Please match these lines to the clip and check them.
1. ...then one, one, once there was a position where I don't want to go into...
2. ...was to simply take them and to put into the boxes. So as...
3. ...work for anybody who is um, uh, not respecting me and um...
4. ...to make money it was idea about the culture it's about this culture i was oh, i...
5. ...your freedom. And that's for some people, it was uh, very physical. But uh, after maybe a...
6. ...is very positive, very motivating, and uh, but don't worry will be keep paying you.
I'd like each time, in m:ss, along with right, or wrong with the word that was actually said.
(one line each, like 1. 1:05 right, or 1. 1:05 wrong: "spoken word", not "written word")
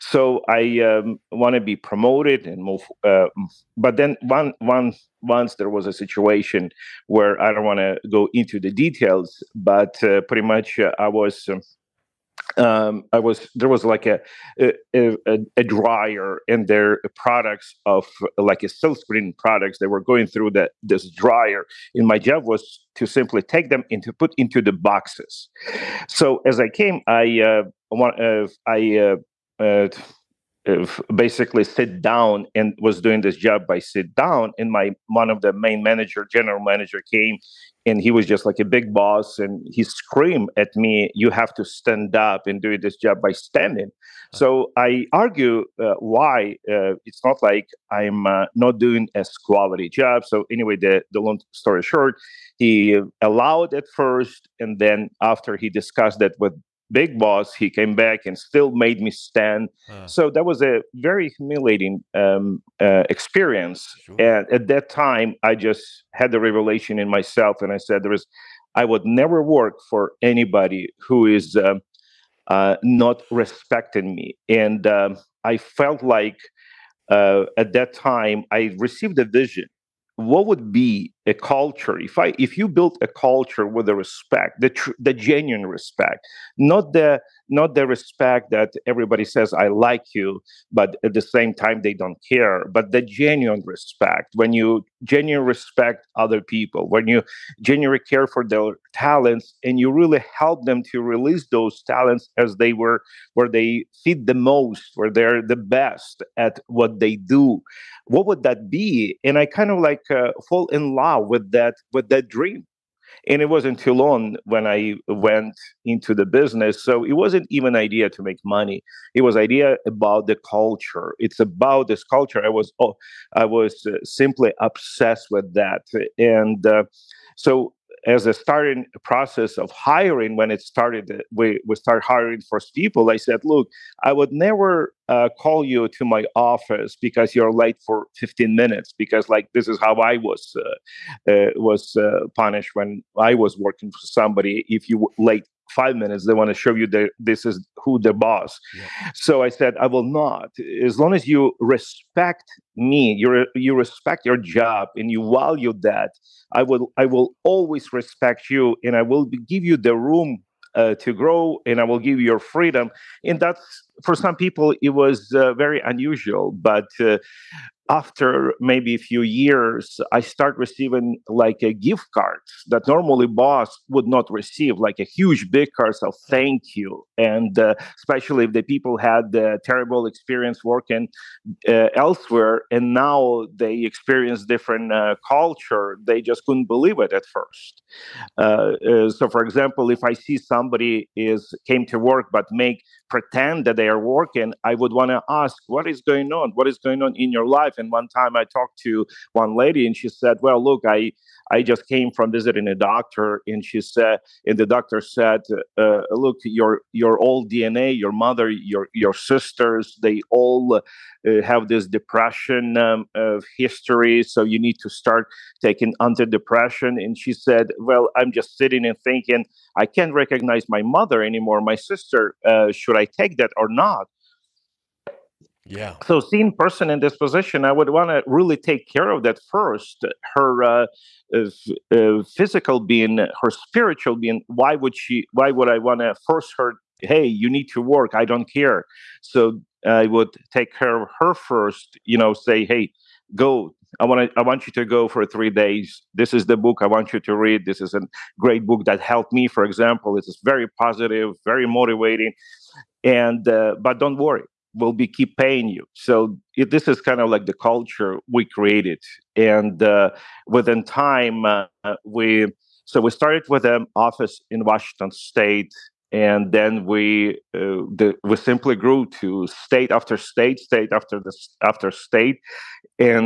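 1. 0:03 wrong: "situation", not "position"
2. 0:22 right
3. 1:09 right
4. 1:58 right
5. 2:42 wrong: "unusual", not "physical"
6. 4:10 right.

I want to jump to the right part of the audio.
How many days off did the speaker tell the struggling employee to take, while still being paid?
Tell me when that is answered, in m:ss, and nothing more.
4:05.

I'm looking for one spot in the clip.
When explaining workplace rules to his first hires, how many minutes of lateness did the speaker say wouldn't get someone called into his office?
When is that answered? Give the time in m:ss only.
2:18.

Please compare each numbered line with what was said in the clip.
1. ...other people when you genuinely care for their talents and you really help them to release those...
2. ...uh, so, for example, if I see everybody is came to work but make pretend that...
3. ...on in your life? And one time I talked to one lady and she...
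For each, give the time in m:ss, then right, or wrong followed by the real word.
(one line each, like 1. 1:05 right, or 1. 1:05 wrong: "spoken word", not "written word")
1. 1:36 right
2. 3:08 wrong: "somebody", not "everybody"
3. 3:17 right.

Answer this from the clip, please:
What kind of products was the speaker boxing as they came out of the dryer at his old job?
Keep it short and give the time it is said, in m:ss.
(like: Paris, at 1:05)
silk screen products, at 0:18.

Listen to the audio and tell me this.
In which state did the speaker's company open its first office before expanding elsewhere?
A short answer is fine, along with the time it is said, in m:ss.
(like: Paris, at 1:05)
Washington, at 4:24.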